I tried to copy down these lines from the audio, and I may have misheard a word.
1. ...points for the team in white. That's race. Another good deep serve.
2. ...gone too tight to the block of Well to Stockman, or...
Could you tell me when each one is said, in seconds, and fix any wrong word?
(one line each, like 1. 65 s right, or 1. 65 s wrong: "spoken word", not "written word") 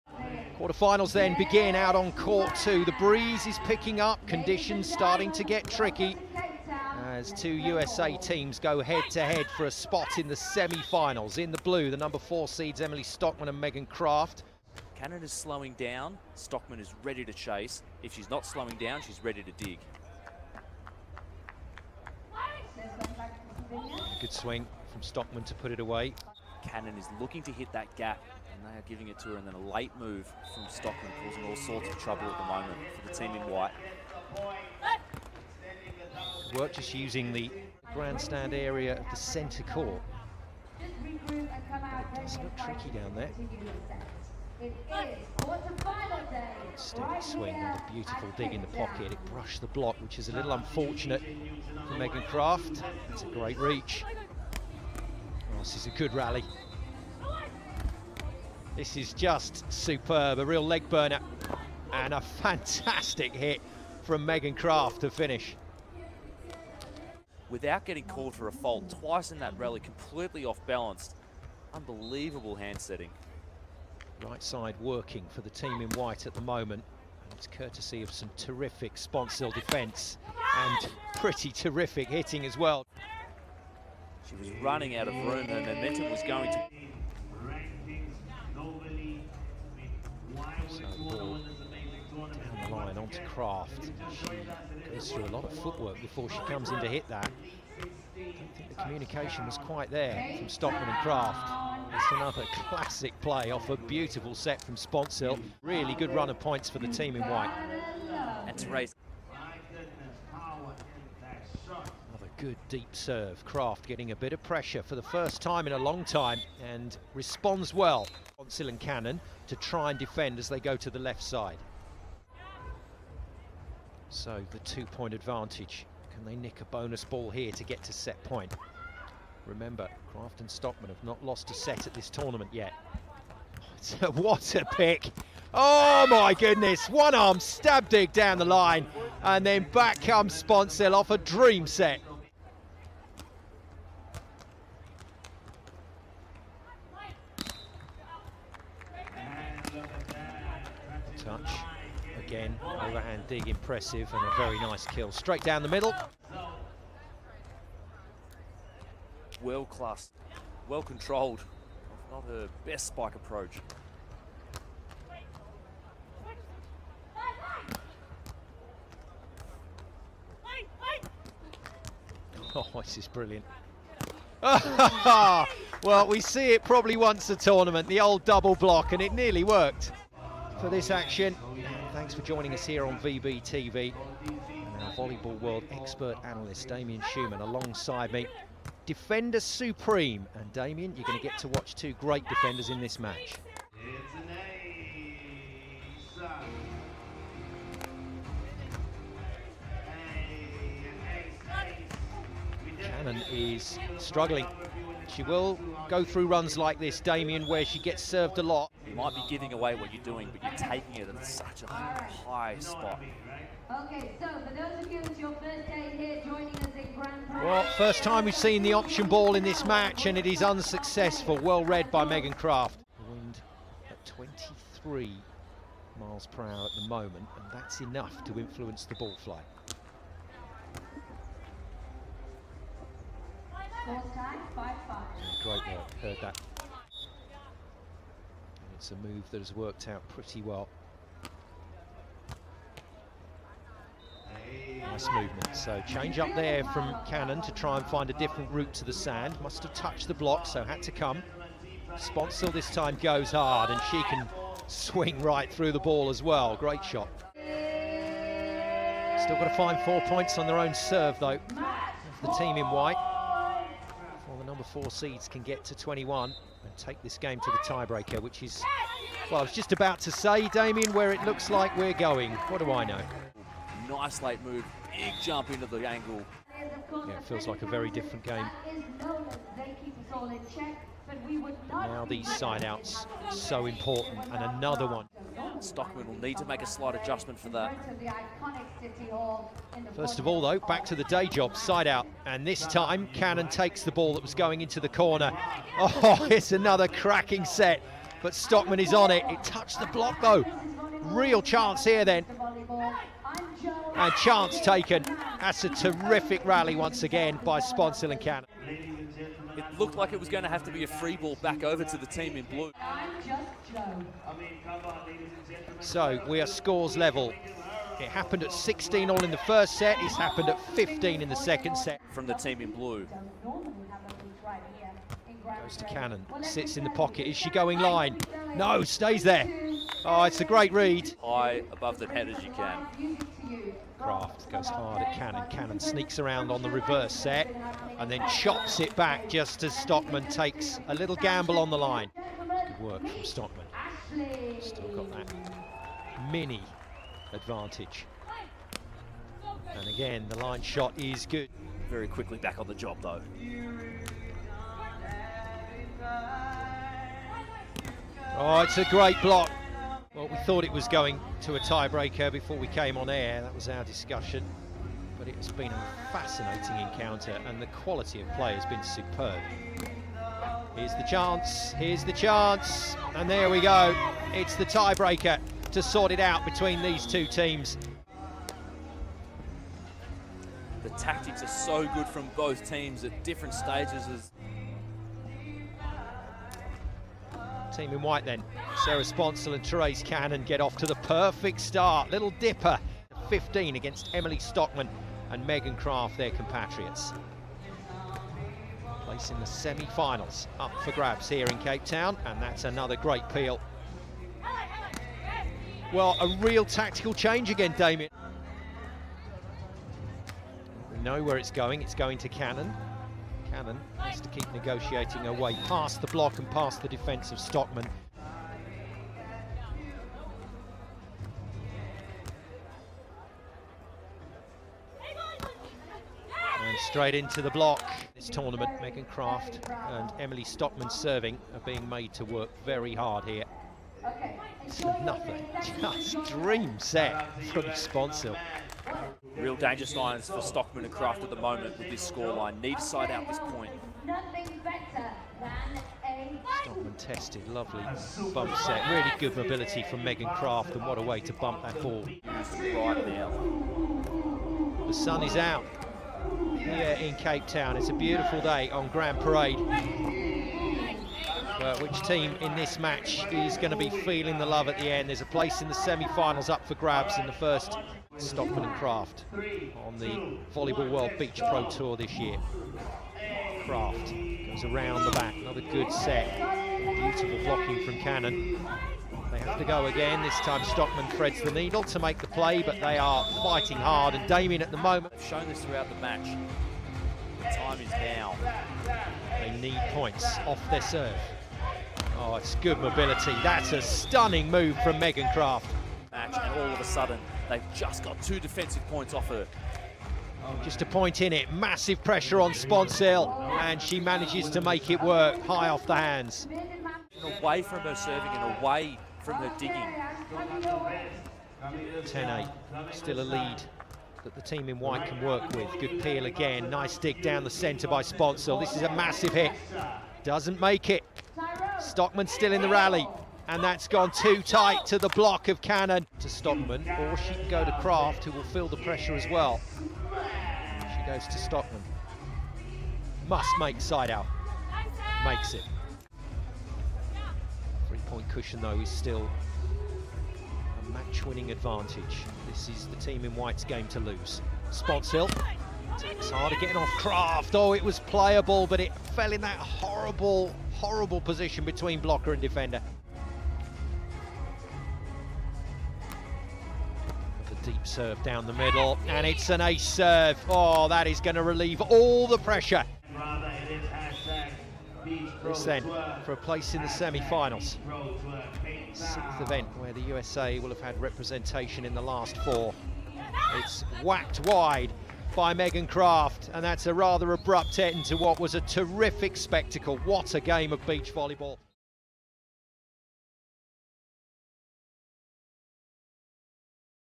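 1. 106 s right
2. 523 s wrong: "Cannon", not "Well".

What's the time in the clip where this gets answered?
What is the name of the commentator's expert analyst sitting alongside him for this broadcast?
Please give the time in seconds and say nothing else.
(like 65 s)
186 s.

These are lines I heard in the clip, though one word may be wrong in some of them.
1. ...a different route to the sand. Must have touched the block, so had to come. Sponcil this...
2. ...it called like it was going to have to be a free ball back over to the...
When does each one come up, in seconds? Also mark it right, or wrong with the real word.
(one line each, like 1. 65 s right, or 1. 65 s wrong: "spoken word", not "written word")
1. 248 s right
2. 309 s wrong: "looked", not "called".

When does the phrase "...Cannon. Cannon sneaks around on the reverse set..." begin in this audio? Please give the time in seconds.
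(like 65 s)
335 s.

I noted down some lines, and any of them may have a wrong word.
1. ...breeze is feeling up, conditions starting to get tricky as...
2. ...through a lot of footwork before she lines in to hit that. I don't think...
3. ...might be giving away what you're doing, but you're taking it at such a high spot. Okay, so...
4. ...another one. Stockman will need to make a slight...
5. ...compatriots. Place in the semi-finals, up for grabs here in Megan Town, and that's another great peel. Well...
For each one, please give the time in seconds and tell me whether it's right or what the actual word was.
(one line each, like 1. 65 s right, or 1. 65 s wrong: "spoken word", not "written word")
1. 2 s wrong: "picking", not "feeling"
2. 95 s wrong: "comes", not "lines"
3. 208 s right
4. 284 s right
5. 396 s wrong: "Cape", not "Megan".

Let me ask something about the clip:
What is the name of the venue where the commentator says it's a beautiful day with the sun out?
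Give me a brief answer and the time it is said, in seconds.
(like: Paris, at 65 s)
Grand Parade, at 458 s.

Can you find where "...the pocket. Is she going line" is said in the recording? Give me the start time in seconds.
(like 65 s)
326 s.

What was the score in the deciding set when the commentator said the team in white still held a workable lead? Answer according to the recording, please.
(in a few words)
10-8.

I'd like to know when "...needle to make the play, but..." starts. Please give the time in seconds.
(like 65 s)
481 s.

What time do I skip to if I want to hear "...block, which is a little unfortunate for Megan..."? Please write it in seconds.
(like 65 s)
49 s.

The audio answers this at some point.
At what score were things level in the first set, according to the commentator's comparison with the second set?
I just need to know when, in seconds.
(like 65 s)
318 s.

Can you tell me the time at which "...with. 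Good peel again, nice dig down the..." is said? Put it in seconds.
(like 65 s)
515 s.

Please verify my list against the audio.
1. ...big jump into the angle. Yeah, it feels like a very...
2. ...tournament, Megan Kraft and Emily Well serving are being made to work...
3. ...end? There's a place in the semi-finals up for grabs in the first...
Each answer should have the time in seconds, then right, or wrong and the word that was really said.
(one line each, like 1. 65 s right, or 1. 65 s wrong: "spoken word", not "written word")
1. 274 s right
2. 428 s wrong: "Stockman", not "Well"
3. 464 s right.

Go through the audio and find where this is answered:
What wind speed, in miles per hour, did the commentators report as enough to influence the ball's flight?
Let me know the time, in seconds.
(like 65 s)
224 s.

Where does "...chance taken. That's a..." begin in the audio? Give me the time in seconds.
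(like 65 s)
304 s.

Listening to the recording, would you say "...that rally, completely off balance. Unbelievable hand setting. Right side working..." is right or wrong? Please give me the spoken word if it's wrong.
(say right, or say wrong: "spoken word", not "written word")
right.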